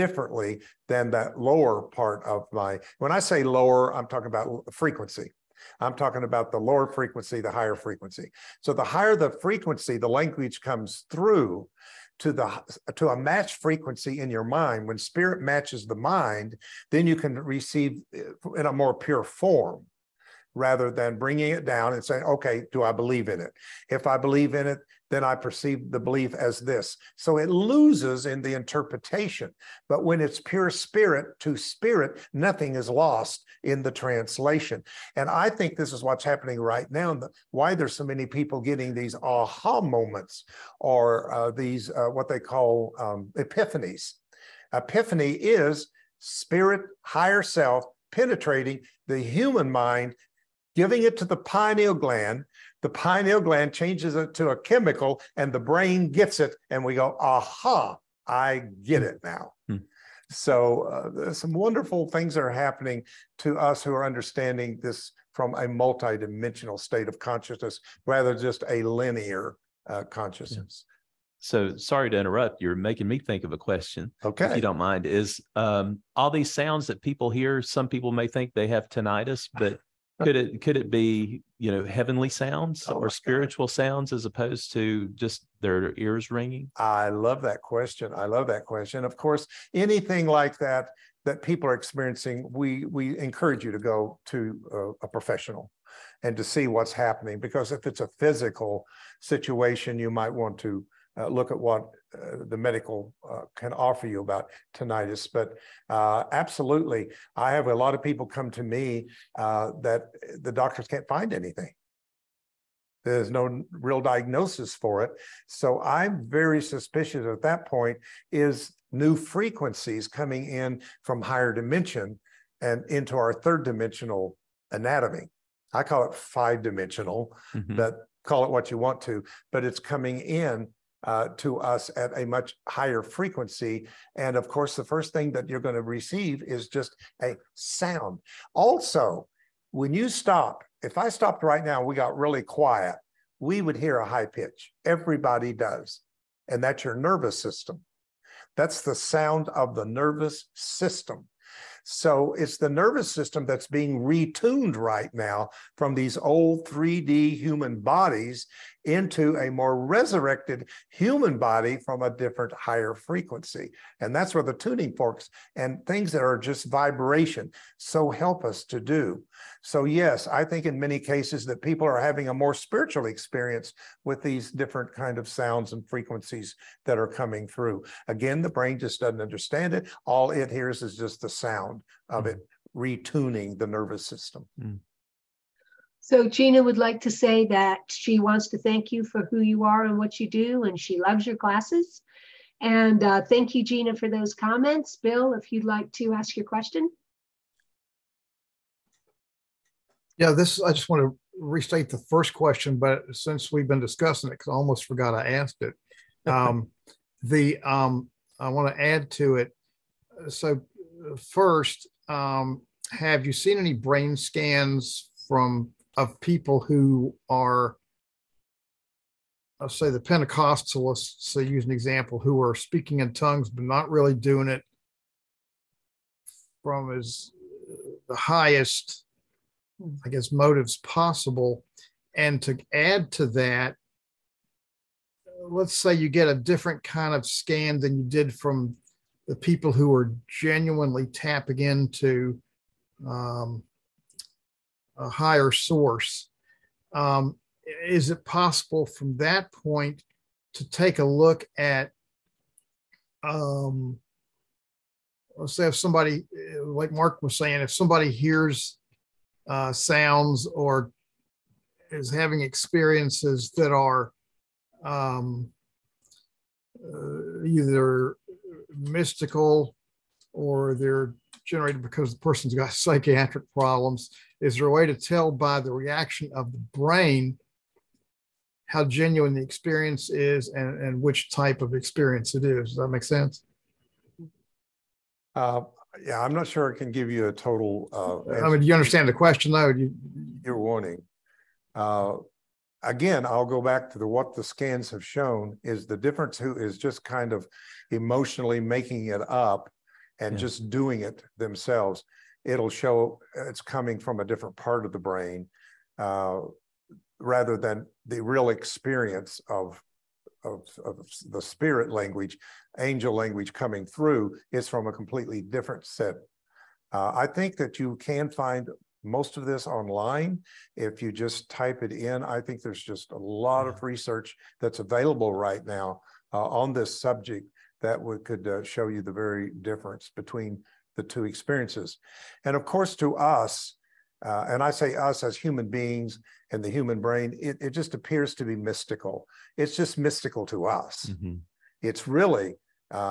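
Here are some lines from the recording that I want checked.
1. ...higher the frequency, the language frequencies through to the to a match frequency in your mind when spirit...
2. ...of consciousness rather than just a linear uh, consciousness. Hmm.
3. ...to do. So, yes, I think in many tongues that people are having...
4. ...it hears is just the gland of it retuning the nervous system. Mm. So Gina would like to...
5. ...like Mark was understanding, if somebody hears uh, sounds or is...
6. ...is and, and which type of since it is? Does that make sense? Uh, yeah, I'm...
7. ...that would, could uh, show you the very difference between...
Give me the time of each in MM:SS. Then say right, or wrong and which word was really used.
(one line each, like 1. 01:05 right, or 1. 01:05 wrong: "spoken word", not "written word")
1. 00:08 wrong: "comes", not "frequencies"
2. 01:07 right
3. 02:48 wrong: "cases", not "tongues"
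4. 03:00 wrong: "sound", not "gland"
5. 04:16 wrong: "saying", not "understanding"
6. 04:40 wrong: "experience", not "since"
7. 05:27 right.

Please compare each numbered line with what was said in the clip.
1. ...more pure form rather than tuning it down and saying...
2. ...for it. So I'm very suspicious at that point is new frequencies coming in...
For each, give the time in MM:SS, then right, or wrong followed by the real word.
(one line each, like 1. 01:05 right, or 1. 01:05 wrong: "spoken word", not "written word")
1. 00:18 wrong: "bringing", not "tuning"
2. 01:54 right.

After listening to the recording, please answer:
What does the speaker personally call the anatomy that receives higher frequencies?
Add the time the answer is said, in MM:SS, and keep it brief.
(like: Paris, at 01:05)
five dimensional, at 02:06.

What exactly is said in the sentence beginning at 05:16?
Uh, I think that you can find most of this online.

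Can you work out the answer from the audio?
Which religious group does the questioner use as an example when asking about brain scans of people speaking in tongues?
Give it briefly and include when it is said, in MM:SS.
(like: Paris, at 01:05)
Pentecostalists, at 03:39.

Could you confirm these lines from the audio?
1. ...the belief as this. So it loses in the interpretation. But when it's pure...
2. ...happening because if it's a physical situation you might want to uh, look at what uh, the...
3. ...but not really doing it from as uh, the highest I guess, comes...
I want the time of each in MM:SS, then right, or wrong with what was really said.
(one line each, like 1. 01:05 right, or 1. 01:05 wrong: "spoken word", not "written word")
1. 00:25 right
2. 01:36 right
3. 03:43 wrong: "motives", not "comes".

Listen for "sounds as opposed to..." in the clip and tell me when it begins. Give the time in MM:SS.
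01:23.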